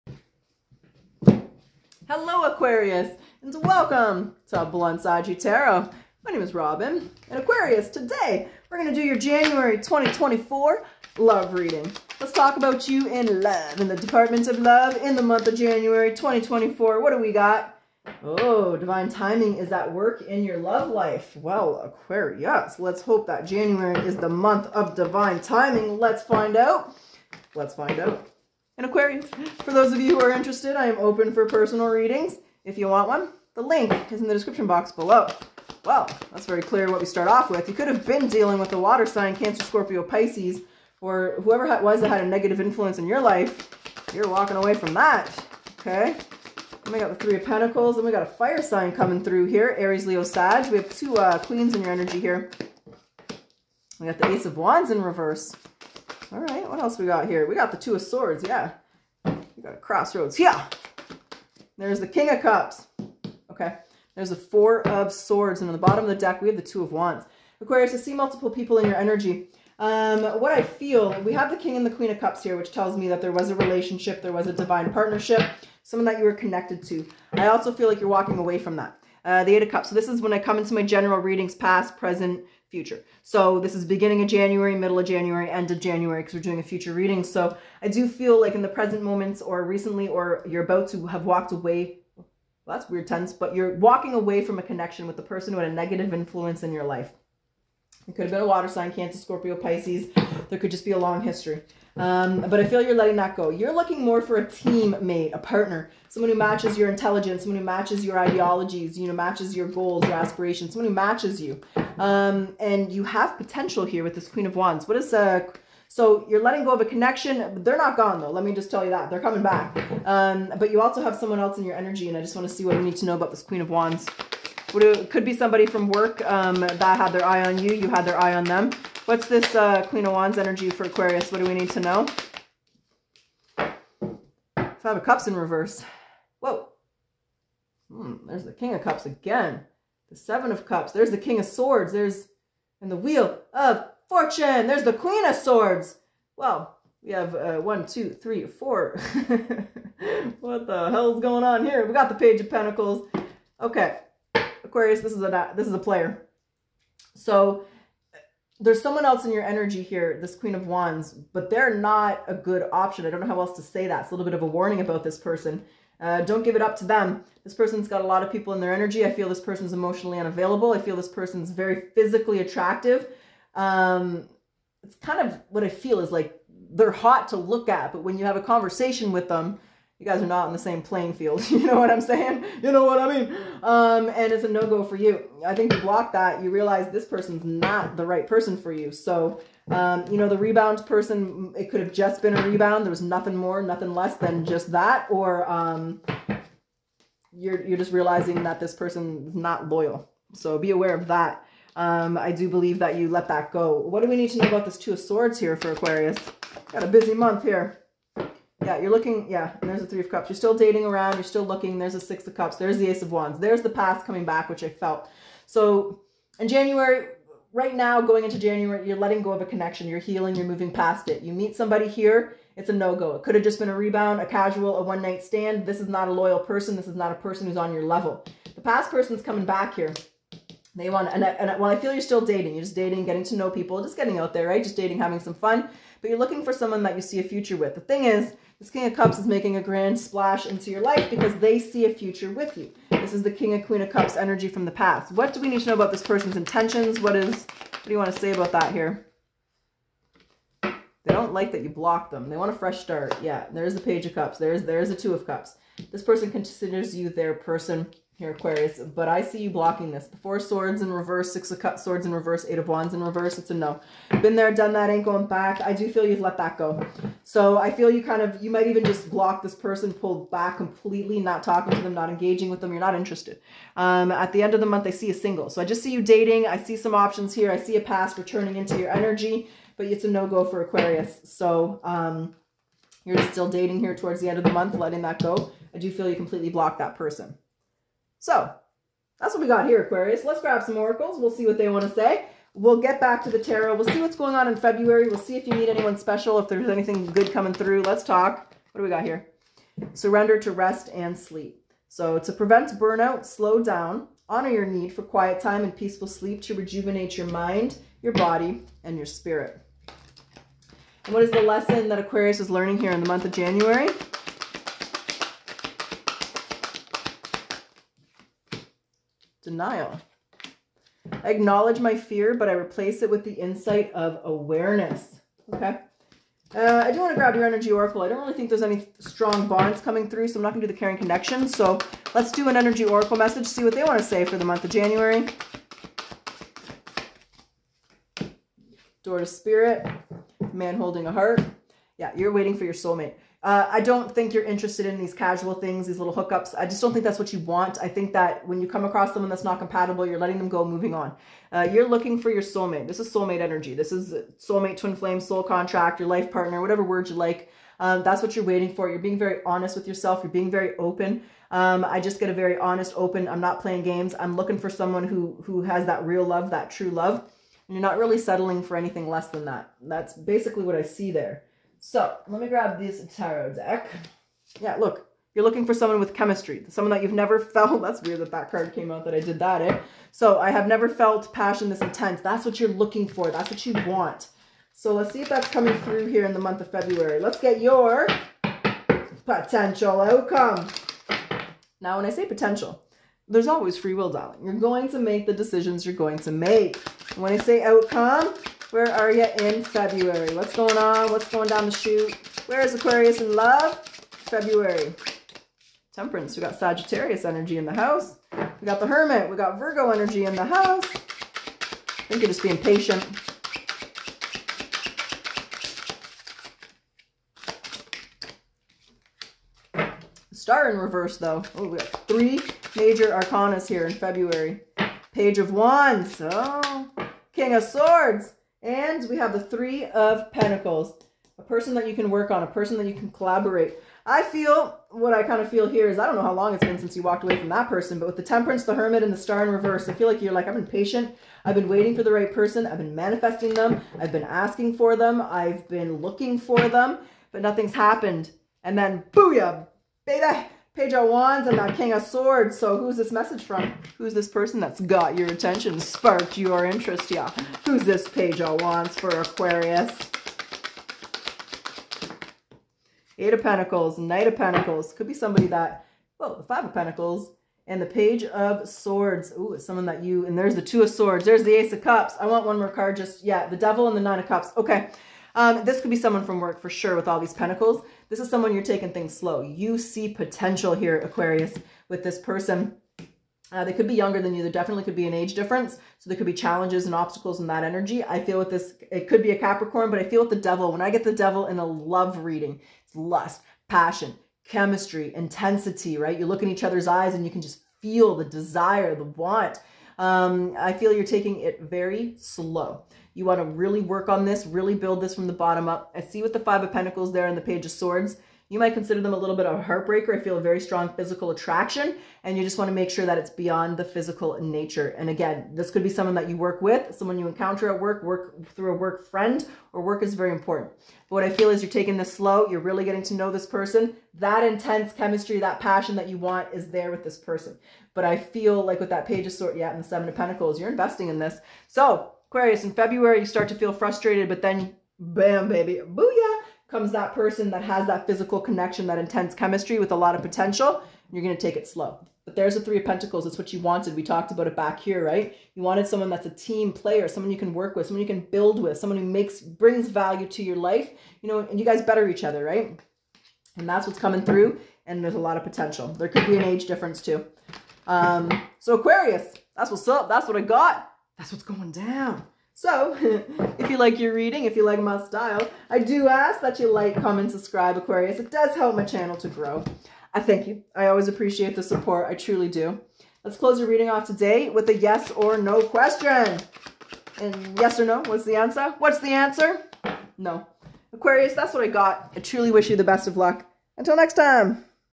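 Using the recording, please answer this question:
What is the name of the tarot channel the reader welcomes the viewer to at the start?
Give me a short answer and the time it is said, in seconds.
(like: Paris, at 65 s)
Bluntsaggie Tarot, at 4 s.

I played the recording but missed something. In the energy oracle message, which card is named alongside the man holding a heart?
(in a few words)
Door to spirit.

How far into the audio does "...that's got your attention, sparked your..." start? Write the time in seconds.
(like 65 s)
454 s.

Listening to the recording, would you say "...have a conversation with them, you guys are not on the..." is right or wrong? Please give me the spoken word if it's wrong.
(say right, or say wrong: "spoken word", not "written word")
right.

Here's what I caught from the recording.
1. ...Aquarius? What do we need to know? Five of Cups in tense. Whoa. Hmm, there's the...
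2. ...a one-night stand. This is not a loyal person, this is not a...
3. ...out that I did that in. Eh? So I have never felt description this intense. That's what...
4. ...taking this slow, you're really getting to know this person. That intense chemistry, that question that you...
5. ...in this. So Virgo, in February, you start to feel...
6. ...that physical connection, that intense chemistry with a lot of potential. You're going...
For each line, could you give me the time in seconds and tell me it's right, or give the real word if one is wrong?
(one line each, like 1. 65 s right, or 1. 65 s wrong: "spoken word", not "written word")
1. 130 s wrong: "reverse", not "tense"
2. 224 s right
3. 378 s wrong: "passion", not "description"
4. 521 s wrong: "passion", not "question"
5. 531 s wrong: "Aquarius", not "Virgo"
6. 537 s right.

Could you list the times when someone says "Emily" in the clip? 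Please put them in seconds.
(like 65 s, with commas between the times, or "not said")
not said.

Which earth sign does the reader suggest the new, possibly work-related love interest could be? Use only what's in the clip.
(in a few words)
Capricorn.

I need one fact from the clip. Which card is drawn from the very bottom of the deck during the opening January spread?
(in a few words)
Two of Wands.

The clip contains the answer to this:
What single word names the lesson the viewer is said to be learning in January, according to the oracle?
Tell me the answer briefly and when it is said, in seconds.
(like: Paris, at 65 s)
Denial, at 319 s.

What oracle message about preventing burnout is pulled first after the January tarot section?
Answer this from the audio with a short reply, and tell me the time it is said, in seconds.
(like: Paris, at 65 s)
Surrender to rest and sleep, at 299 s.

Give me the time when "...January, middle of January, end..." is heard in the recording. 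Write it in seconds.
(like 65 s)
84 s.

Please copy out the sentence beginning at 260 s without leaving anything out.
The Four Swords in reverse, Six of Cups, Swords in reverse, Eight of Wands in reverse.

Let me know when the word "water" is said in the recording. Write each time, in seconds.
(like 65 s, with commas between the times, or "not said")
38 s, 98 s.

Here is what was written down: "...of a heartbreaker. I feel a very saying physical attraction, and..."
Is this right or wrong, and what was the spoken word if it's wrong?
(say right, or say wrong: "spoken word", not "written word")
wrong: "strong", not "saying".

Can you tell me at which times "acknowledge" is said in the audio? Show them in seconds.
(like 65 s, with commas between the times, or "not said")
321 s.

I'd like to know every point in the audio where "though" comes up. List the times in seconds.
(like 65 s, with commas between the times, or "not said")
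118 s, 421 s.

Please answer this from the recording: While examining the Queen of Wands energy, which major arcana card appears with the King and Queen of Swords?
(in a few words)
Wheel of Fortune.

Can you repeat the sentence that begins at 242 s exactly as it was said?
This is the King of Queen of Cups energy from the past.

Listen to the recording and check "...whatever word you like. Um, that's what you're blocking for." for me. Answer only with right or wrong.
wrong.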